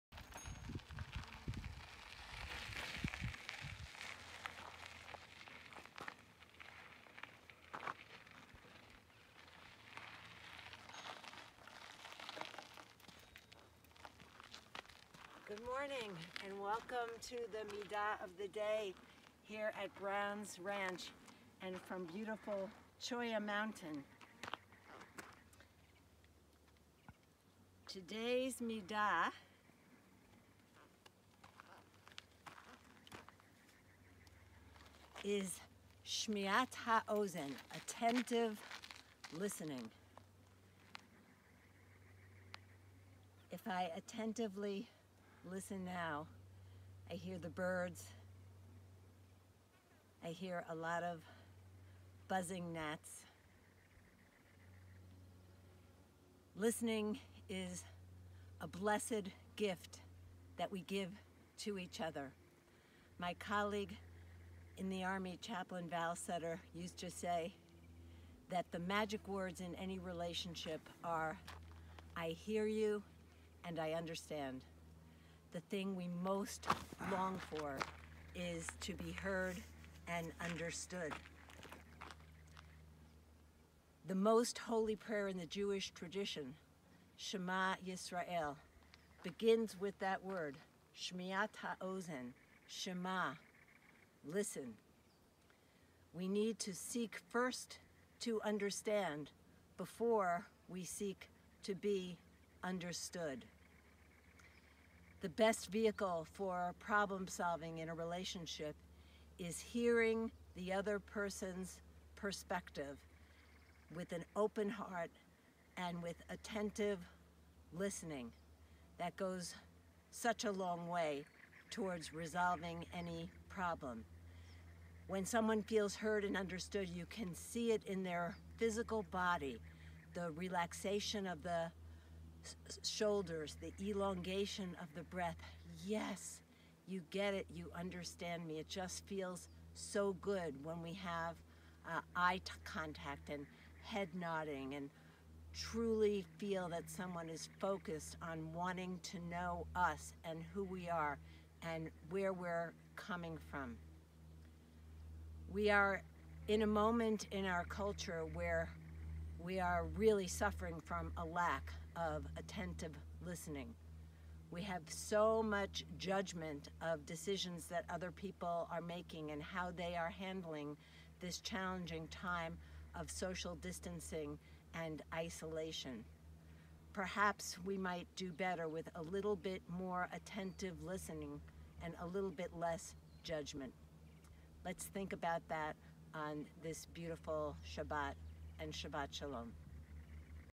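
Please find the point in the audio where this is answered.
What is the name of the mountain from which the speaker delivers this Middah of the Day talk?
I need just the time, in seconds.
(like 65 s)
23 s.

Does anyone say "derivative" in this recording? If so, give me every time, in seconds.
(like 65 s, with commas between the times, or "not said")
not said.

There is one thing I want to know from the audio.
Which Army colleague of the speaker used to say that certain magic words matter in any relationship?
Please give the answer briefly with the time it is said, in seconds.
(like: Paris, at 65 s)
Chaplain Val Sutter, at 65 s.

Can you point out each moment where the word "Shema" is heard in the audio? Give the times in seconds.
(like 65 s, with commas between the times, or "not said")
87 s, 92 s.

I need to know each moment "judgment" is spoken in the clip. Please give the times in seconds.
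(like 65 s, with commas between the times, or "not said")
165 s, 183 s.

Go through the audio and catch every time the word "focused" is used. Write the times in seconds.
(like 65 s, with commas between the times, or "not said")
147 s.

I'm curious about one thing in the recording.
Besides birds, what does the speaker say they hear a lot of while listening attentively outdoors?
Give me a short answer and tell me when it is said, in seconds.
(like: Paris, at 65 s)
gnats, at 52 s.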